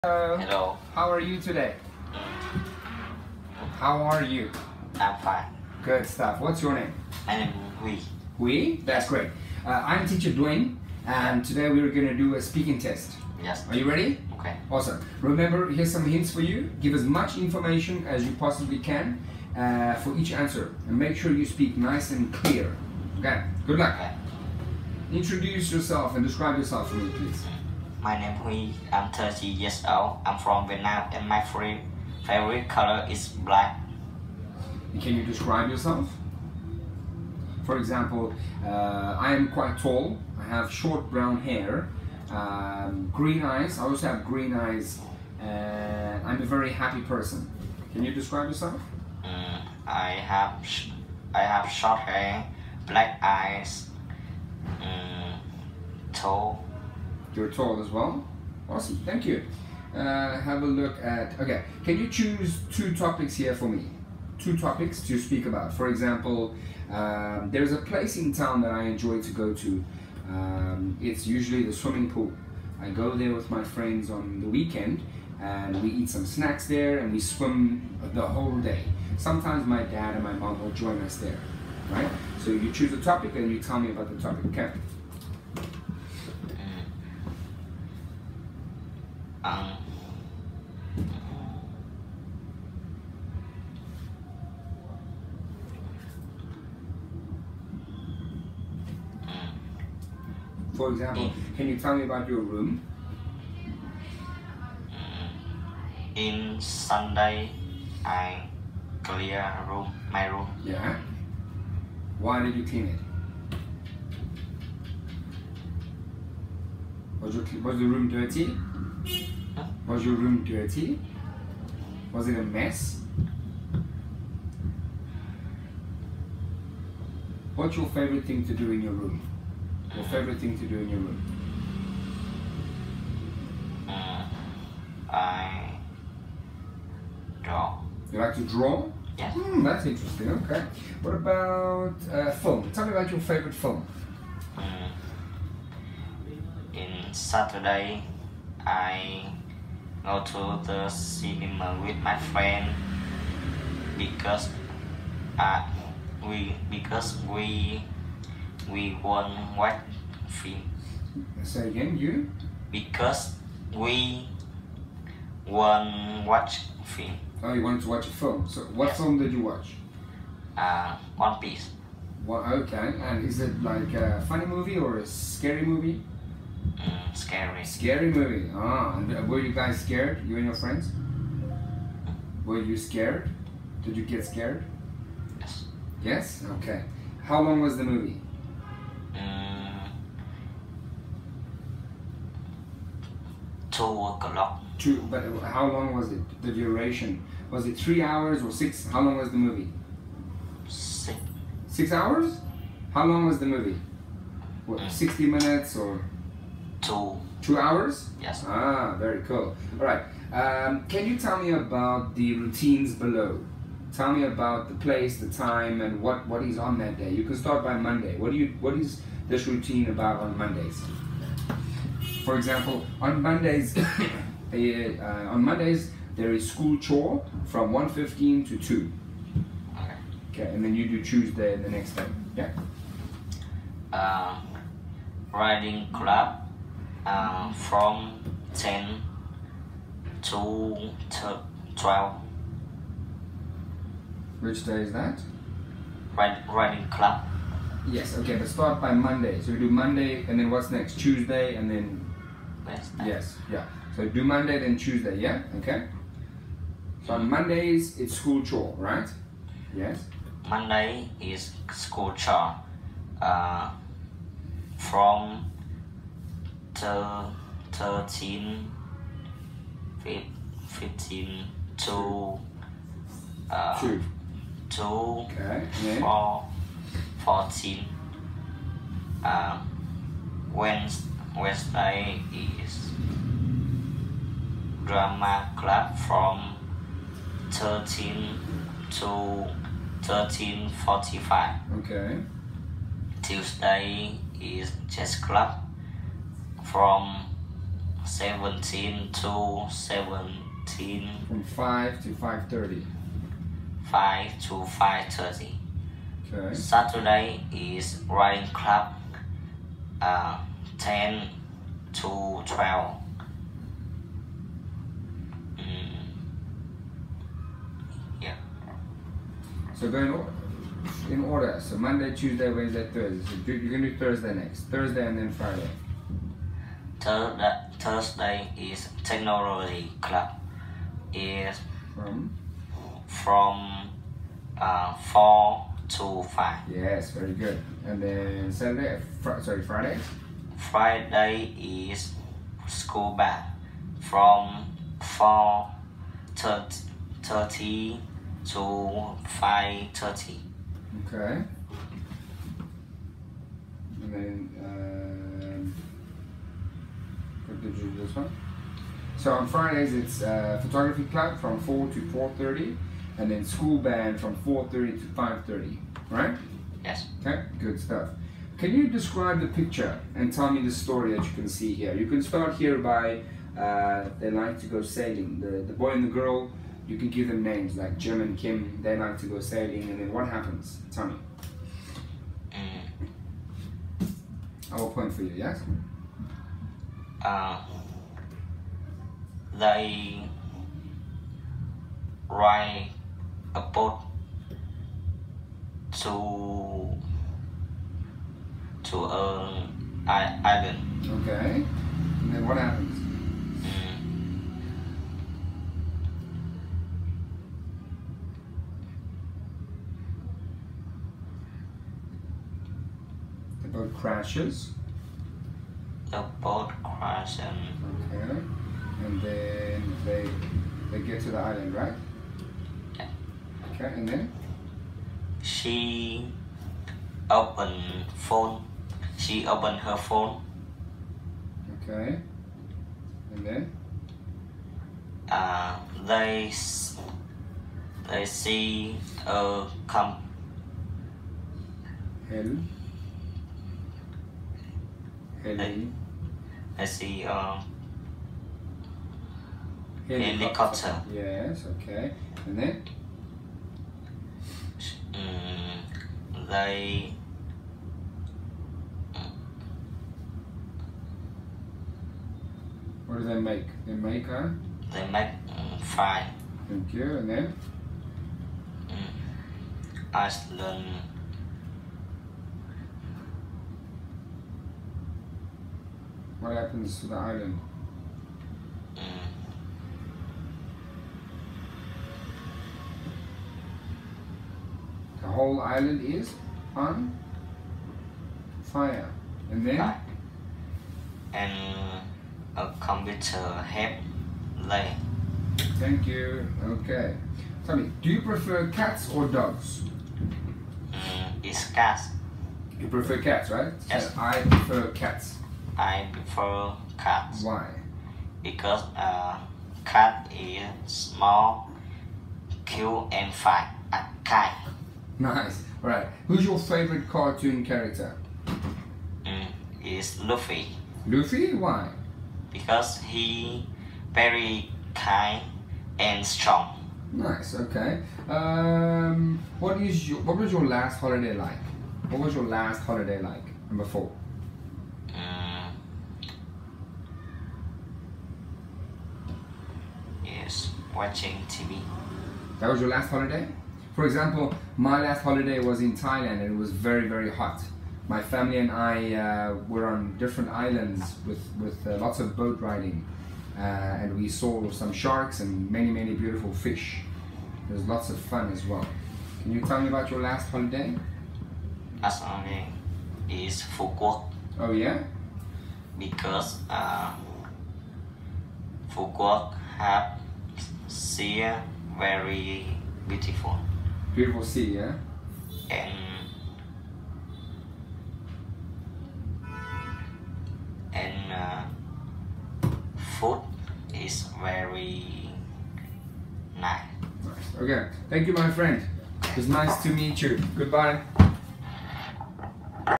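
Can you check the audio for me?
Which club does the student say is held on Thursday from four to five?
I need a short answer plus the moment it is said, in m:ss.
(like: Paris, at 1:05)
technology club, at 5:29.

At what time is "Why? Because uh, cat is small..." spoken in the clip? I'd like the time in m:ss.
8:27.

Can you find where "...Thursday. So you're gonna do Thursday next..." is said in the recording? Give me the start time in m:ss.
5:22.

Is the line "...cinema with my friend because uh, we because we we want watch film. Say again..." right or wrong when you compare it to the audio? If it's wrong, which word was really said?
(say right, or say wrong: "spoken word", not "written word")
right.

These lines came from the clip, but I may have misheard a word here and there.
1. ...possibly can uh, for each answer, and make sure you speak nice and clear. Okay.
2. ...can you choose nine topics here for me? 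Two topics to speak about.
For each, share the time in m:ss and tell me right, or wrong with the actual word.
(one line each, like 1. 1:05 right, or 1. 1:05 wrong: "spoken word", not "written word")
1. 0:18 right
2. 1:01 wrong: "two", not "nine".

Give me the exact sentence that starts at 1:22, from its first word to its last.
So you choose a topic and you tell me about the topic, okay?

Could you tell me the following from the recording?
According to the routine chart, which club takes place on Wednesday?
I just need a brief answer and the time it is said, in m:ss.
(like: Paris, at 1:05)
drama club, at 4:44.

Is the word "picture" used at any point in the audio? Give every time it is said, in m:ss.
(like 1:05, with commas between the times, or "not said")
6:09.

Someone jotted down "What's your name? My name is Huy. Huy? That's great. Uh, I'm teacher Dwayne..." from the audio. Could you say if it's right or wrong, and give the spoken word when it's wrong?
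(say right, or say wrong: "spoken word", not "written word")
right.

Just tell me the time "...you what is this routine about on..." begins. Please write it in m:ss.
3:38.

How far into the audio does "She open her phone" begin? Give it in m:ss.
7:09.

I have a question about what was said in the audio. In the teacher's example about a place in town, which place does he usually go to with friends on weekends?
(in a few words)
the swimming pool.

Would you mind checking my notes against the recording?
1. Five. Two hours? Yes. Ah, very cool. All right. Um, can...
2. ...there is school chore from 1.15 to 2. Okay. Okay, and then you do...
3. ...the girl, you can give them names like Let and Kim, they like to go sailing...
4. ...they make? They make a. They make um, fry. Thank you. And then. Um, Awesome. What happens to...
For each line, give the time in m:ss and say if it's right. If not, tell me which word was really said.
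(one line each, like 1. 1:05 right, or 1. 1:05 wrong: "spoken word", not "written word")
1. 3:26 wrong: "Two", not "Five"
2. 3:46 right
3. 6:16 wrong: "Jim", not "Let"
4. 7:43 wrong: "Iceland", not "Awesome".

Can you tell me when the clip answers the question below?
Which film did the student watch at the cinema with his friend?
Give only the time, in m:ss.
2:51.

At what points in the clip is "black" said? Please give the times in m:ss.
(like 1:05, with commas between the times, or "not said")
0:33, 0:52.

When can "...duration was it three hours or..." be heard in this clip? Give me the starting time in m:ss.
3:16.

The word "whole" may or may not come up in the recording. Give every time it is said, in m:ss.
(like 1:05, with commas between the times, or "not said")
1:18, 8:05.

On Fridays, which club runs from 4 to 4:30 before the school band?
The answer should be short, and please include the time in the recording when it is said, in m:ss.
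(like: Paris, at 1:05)
photography club, at 6:00.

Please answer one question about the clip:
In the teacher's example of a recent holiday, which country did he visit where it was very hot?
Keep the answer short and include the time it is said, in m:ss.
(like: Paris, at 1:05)
Thailand, at 9:05.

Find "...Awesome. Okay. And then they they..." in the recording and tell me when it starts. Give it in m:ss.
6:57.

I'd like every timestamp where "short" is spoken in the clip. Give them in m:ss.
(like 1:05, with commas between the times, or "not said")
0:40, 0:51.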